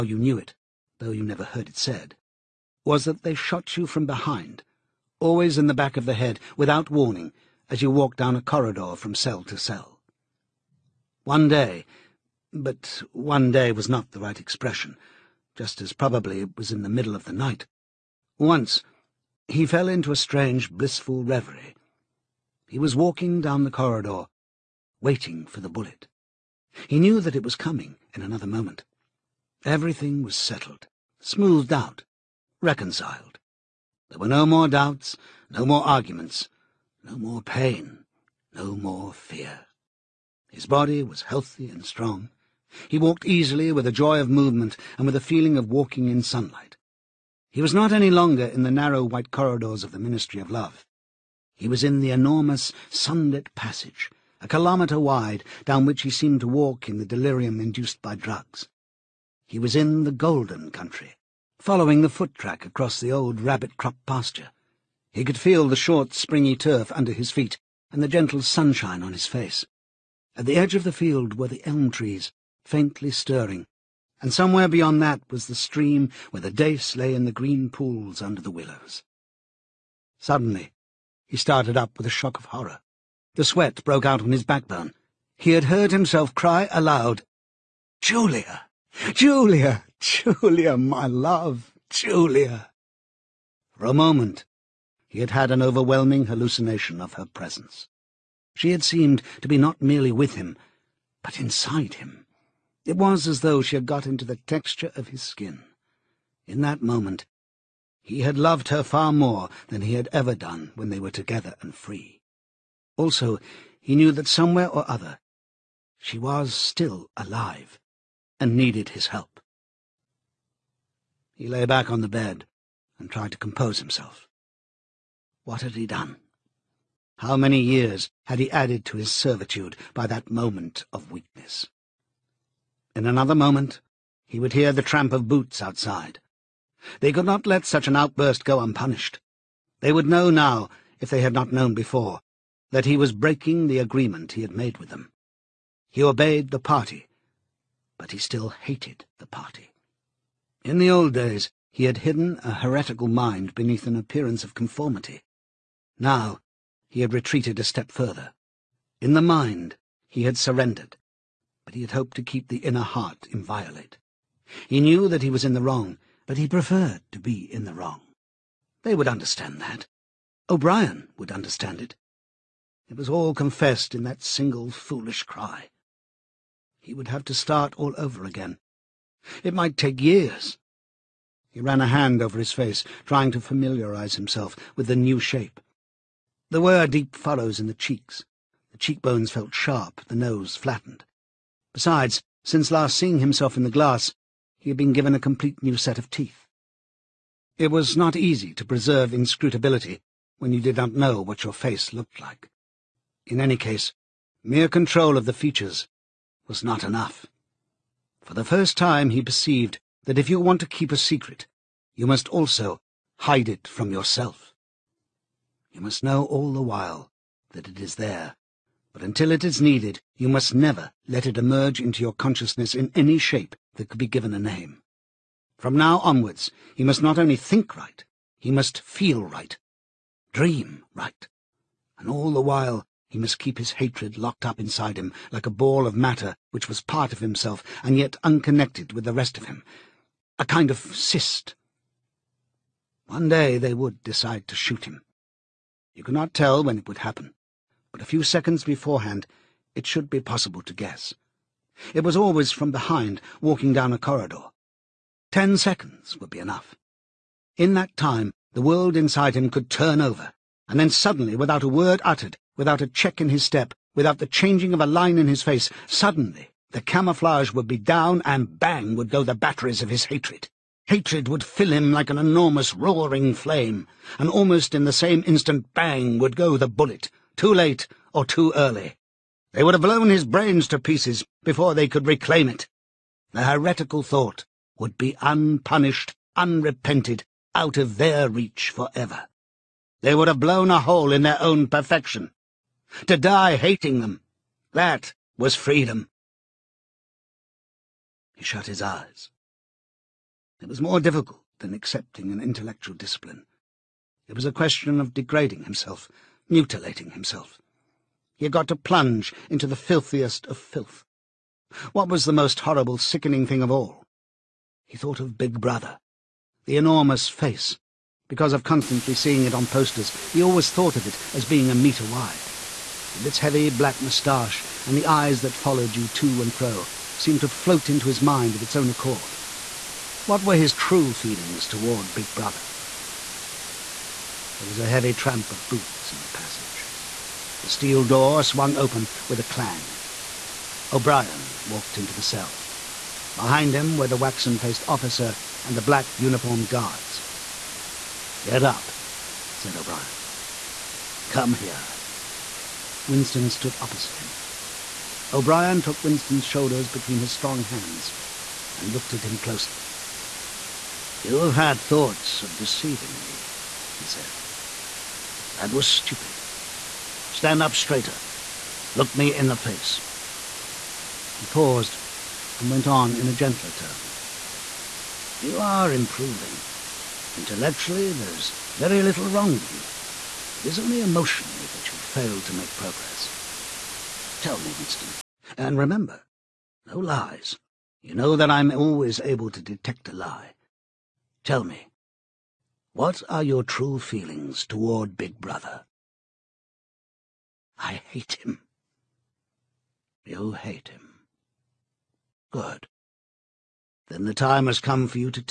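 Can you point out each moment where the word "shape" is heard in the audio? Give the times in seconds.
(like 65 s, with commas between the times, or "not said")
185 s, 223 s.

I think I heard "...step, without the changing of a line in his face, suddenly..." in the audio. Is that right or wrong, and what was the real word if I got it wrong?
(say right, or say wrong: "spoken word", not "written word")
right.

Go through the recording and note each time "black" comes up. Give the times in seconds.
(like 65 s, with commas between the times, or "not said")
323 s, 345 s.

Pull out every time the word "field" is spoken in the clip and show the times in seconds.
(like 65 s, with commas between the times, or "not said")
70 s.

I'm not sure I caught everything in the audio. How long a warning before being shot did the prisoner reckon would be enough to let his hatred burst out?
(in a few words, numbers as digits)
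10 seconds.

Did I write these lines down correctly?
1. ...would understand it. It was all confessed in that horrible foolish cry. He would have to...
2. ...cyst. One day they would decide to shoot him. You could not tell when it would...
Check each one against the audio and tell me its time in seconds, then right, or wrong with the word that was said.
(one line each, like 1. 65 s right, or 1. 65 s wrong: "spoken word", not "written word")
1. 171 s wrong: "single", not "horrible"
2. 240 s right.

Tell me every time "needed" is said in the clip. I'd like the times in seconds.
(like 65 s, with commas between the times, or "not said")
118 s, 219 s.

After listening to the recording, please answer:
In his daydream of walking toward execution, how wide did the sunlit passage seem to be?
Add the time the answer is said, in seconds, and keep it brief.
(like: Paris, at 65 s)
1 kilometre, at 54 s.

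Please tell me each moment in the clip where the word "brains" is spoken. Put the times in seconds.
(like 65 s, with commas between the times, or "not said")
280 s.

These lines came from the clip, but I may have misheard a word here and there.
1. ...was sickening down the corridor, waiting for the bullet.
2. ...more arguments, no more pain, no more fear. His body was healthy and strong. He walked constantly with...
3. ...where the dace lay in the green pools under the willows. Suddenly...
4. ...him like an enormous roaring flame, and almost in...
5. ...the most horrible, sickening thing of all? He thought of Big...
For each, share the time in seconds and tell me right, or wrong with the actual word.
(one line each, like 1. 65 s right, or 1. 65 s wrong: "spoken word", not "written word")
1. 22 s wrong: "walking", not "sickening"
2. 35 s wrong: "easily", not "constantly"
3. 76 s right
4. 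271 s right
5. 312 s right.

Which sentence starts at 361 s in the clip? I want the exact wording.
You have had thoughts of deceiving me, he said.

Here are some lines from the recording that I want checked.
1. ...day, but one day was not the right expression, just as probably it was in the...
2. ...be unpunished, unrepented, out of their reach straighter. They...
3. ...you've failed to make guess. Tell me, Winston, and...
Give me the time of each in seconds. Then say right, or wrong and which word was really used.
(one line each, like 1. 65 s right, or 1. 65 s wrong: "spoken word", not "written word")
1. 11 s right
2. 284 s wrong: "forever", not "straighter"
3. 381 s wrong: "progress", not "guess".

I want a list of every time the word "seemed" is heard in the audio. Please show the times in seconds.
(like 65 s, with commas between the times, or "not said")
56 s, 98 s, 327 s.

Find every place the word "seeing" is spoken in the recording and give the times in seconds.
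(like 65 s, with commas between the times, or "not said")
192 s, 319 s.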